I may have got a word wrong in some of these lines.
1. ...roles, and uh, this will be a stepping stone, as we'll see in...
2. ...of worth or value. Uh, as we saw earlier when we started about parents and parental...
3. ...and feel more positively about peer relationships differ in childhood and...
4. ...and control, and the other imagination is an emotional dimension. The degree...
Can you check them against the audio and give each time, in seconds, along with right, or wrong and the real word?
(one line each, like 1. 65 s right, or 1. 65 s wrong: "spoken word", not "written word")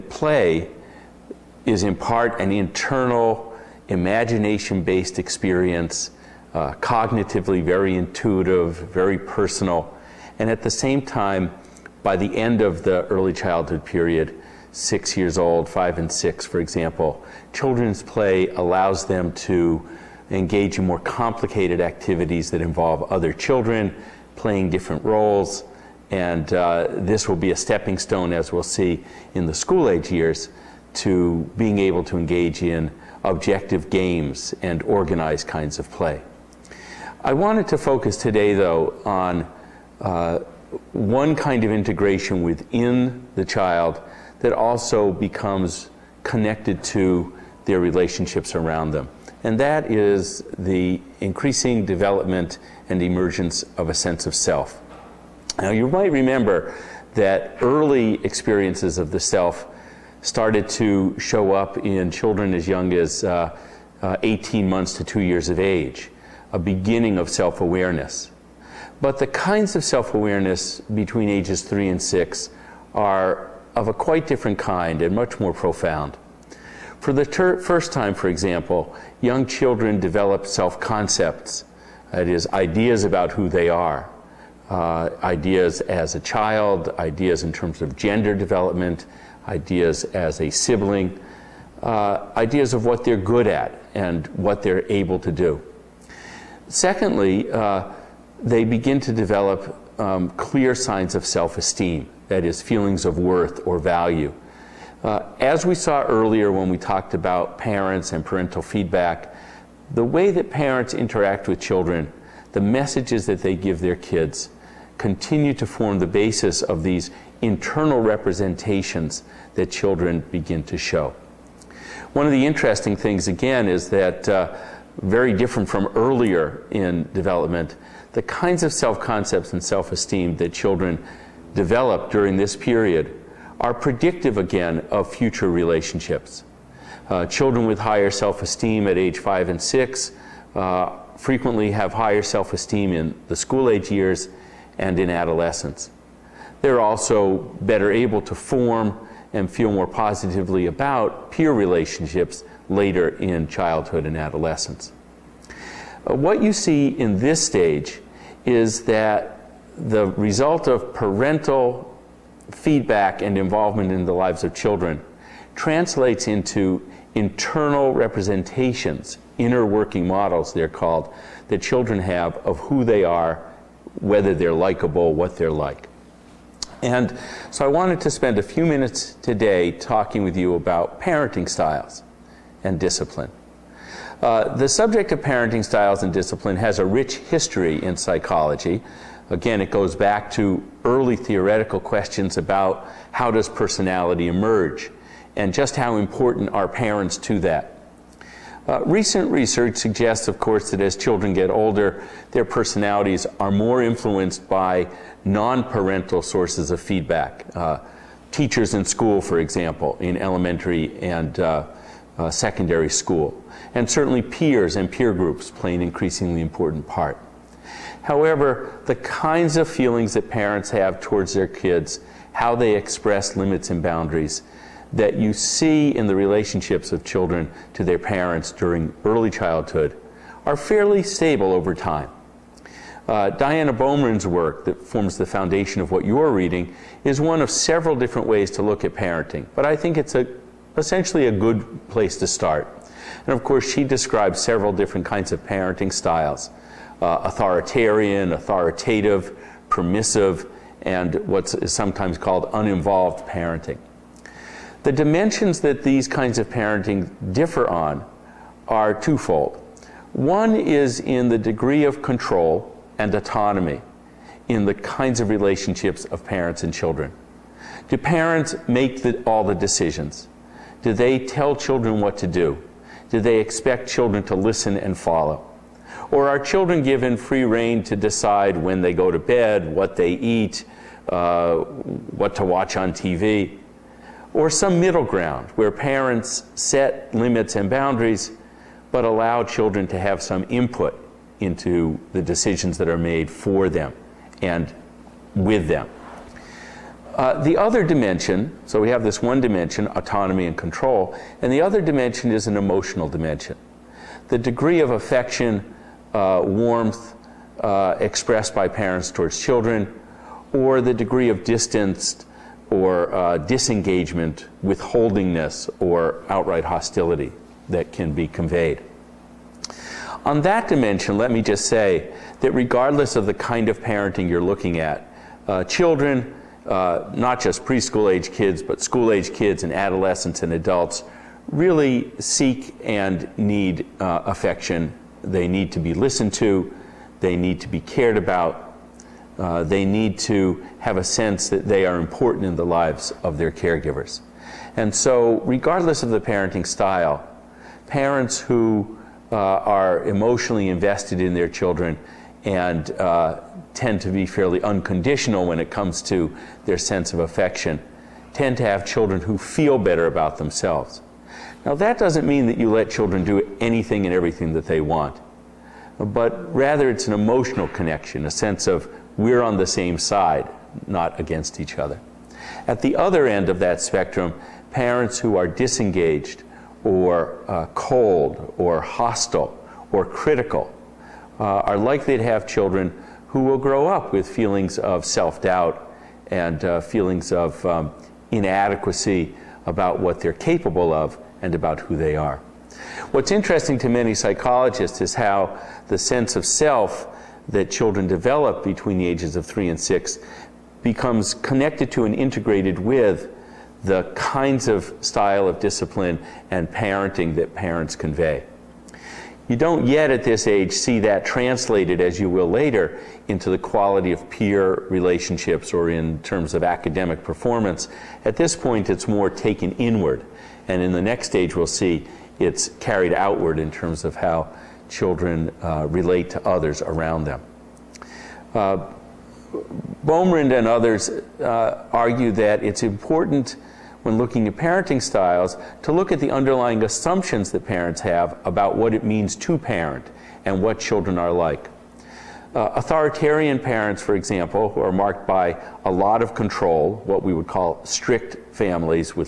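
1. 25 s right
2. 103 s wrong: "talked", not "started"
3. 149 s wrong: "later", not "differ"
4. 300 s wrong: "dimension", not "imagination".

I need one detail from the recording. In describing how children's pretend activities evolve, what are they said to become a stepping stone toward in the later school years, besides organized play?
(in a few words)
objective games.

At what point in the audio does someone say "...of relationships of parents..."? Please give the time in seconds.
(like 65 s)
265 s.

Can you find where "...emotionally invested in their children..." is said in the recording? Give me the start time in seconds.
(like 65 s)
350 s.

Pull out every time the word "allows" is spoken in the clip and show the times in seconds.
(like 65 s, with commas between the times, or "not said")
18 s, 289 s.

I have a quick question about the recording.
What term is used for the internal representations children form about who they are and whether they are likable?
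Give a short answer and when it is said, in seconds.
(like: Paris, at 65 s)
inner working models, at 169 s.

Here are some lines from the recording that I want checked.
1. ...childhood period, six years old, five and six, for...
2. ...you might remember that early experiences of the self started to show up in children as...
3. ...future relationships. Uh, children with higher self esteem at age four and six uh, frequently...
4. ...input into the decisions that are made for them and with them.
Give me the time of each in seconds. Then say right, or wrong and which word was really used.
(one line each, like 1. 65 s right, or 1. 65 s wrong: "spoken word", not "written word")
1. 13 s right
2. 55 s right
3. 135 s wrong: "five", not "four"
4. 290 s right.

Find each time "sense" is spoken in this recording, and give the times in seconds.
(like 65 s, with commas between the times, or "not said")
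53 s, 341 s, 356 s, 368 s, 395 s.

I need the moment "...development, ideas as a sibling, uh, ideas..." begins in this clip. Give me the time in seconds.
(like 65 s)
88 s.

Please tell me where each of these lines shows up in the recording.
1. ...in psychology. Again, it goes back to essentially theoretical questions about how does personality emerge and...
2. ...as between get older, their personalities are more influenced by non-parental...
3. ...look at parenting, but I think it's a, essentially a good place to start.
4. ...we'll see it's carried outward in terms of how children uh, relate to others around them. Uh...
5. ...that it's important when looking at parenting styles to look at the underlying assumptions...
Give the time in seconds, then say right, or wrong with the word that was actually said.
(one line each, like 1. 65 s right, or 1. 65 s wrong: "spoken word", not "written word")
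1. 187 s wrong: "early", not "essentially"
2. 200 s wrong: "children", not "between"
3. 238 s right
4. 421 s right
5. 432 s right.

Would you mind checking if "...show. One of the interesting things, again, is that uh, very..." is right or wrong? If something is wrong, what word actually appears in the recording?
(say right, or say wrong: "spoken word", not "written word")
right.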